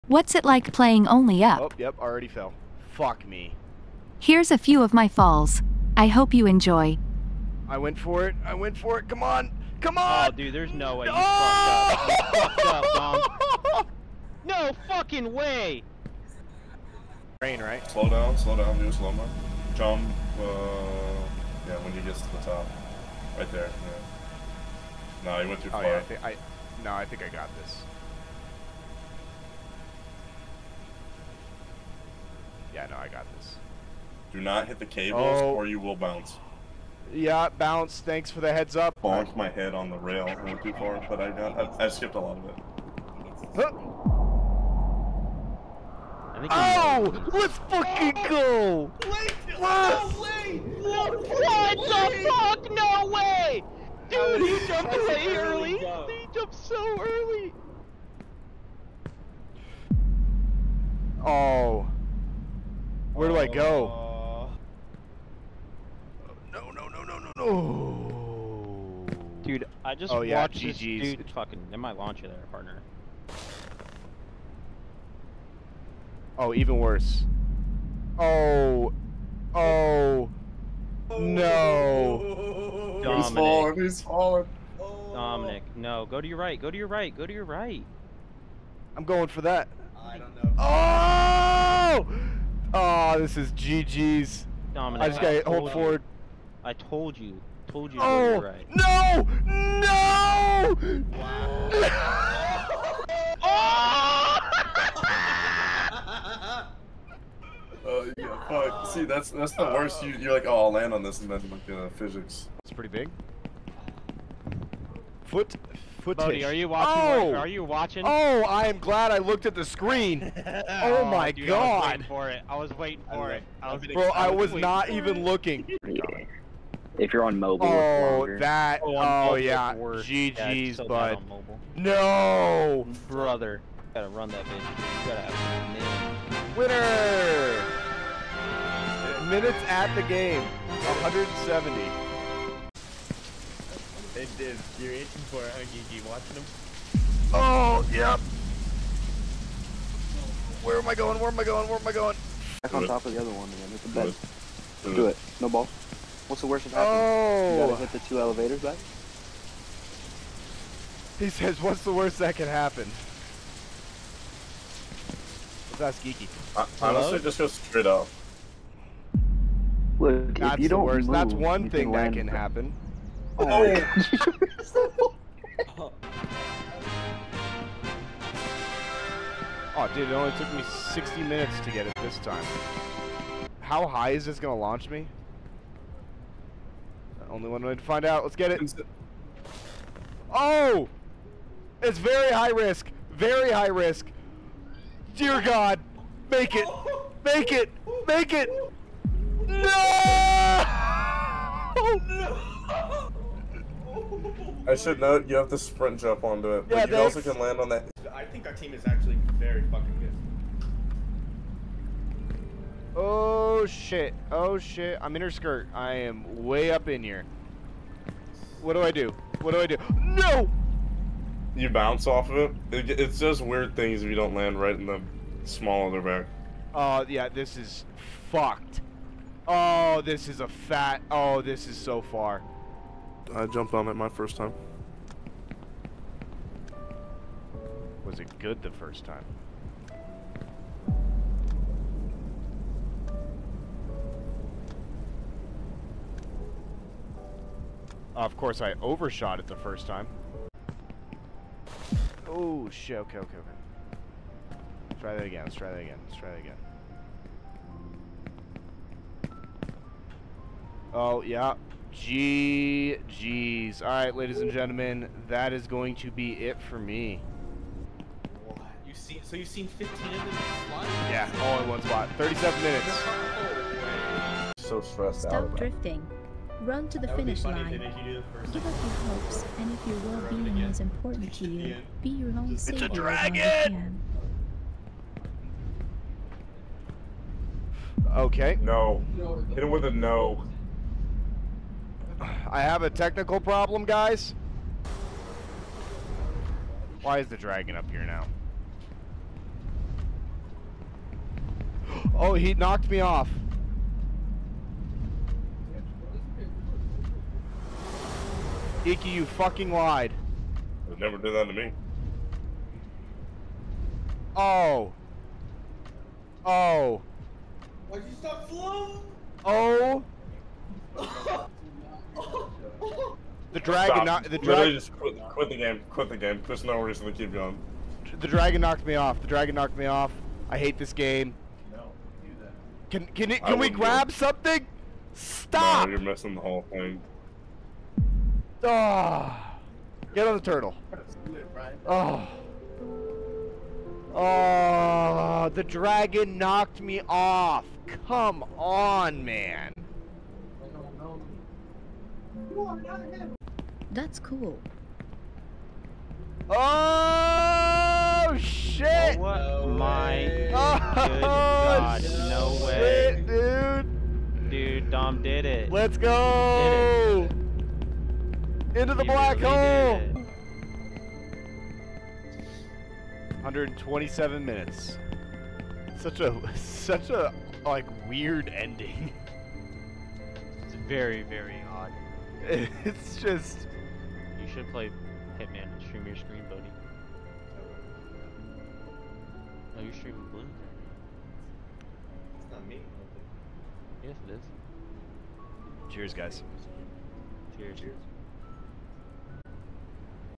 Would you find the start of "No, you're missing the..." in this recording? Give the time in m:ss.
5:35.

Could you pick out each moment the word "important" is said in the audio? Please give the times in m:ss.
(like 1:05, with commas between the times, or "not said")
4:40.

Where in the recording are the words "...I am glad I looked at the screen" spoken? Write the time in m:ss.
1:58.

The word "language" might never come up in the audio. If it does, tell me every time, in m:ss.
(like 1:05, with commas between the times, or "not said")
not said.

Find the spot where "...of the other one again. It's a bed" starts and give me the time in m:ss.
2:33.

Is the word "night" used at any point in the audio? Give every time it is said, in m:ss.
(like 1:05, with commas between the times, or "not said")
not said.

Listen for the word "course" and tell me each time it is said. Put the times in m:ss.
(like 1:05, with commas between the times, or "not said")
4:08.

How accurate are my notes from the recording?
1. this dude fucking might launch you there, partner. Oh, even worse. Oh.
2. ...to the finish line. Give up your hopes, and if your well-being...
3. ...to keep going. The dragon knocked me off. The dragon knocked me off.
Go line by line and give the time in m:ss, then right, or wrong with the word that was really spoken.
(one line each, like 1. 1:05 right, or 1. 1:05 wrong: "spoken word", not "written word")
1. 1:10 right
2. 4:36 right
3. 5:27 right.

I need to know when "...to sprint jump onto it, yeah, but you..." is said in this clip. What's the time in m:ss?
3:25.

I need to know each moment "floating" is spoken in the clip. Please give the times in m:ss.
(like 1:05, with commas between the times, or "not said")
5:18.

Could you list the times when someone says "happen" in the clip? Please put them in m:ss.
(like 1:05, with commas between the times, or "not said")
2:36, 2:42, 2:52.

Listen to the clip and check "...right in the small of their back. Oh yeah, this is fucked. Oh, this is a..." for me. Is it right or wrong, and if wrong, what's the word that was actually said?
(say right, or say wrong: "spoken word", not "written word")
right.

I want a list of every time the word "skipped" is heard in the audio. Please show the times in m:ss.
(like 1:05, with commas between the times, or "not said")
0:41.